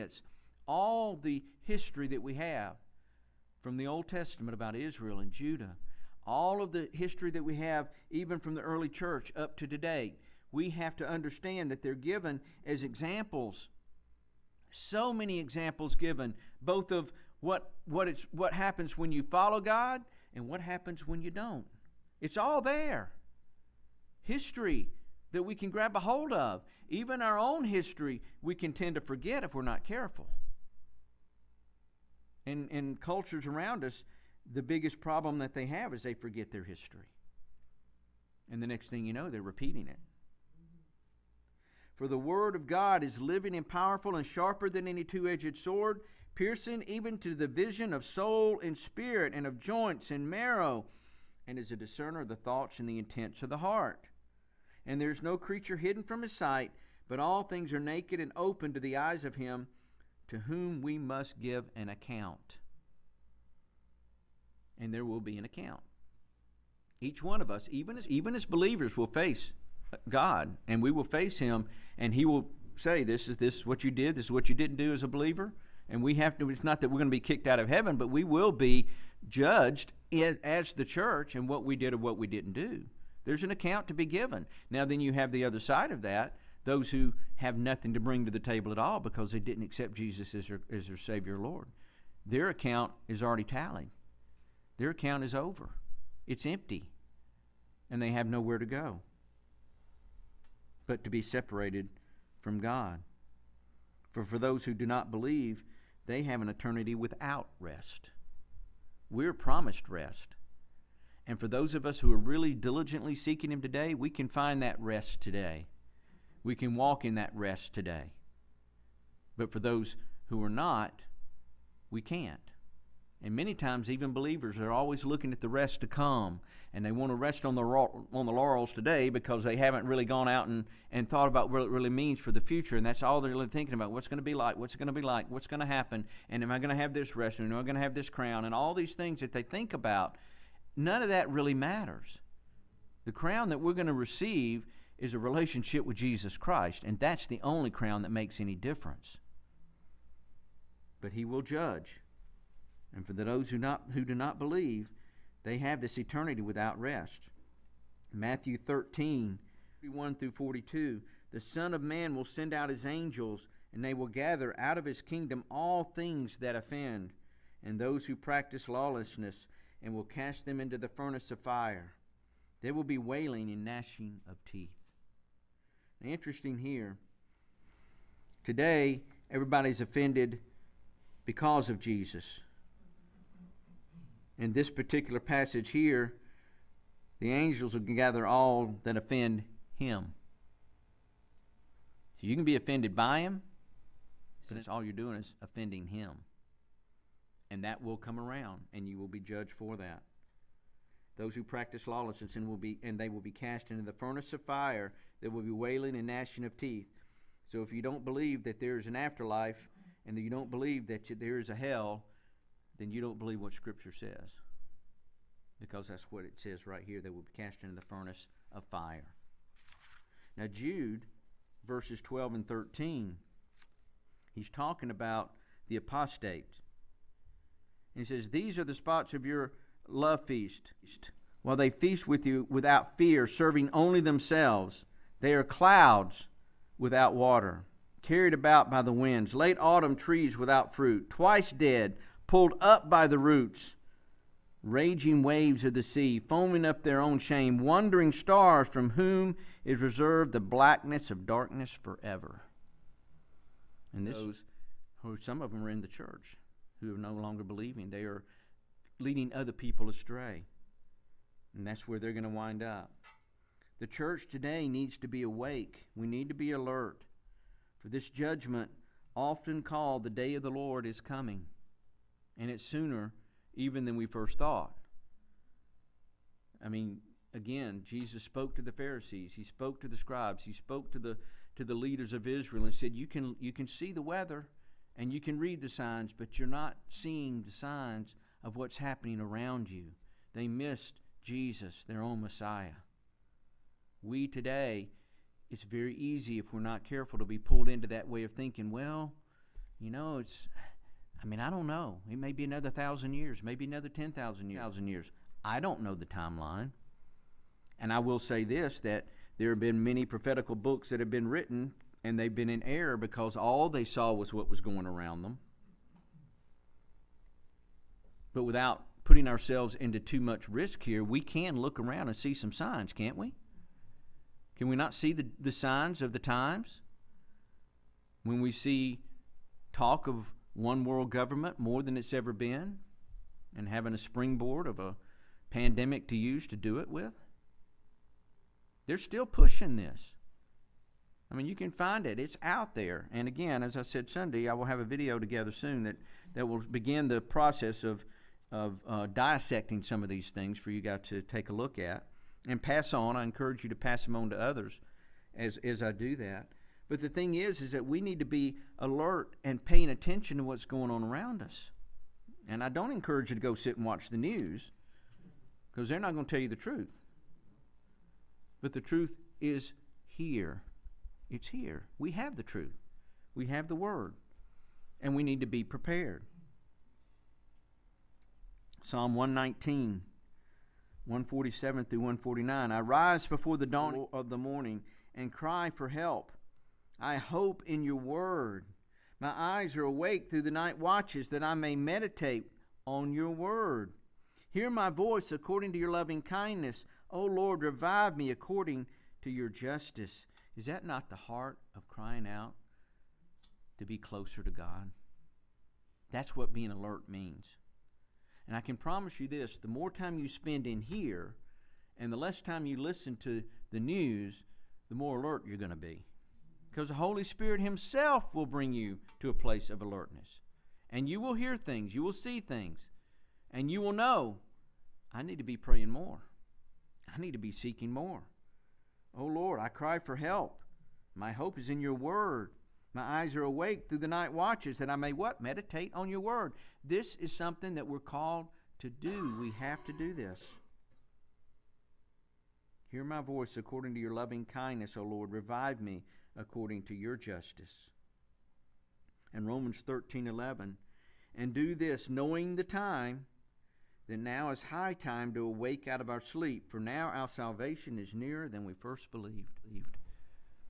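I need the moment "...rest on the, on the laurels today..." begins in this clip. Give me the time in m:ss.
2:07.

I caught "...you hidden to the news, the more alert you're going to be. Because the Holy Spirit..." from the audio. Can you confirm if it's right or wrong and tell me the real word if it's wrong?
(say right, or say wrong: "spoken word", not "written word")
wrong: "listen", not "hidden".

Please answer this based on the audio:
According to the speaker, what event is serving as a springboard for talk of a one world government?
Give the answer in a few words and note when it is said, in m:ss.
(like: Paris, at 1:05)
a pandemic, at 5:34.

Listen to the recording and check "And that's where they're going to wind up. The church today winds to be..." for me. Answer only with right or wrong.
wrong.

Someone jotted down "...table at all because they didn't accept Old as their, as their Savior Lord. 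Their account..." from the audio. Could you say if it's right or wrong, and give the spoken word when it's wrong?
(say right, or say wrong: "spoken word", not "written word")
wrong: "Jesus", not "Old".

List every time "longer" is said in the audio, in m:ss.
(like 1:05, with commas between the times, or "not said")
4:17.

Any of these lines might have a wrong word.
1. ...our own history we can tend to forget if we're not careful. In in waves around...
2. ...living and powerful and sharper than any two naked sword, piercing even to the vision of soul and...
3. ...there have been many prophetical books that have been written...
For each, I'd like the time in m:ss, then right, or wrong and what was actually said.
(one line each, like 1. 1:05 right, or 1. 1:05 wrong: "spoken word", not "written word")
1. 0:27 wrong: "cultures", not "waves"
2. 0:43 wrong: "edged", not "naked"
3. 5:09 right.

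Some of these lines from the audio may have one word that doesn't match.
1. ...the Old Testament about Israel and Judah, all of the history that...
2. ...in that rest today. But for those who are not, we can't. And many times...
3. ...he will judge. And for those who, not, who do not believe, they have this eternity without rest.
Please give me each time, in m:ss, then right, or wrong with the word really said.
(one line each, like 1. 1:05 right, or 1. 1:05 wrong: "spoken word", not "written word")
1. 0:03 right
2. 1:57 right
3. 2:31 right.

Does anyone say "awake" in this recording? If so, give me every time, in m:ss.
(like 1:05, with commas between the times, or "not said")
4:25, 6:29, 7:13, 7:35.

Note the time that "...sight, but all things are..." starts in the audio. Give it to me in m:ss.
0:56.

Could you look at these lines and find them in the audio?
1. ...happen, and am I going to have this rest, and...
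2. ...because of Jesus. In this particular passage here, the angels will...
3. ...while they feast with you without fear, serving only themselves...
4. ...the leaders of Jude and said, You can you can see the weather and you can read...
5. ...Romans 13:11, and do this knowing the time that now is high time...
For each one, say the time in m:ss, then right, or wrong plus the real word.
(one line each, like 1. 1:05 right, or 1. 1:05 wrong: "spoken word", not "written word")
1. 2:15 right
2. 3:01 right
3. 3:51 right
4. 4:41 wrong: "Israel", not "Jude"
5. 7:29 right.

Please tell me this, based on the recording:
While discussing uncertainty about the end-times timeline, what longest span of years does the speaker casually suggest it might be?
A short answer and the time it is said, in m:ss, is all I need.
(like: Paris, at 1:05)
10,000 years, at 5:03.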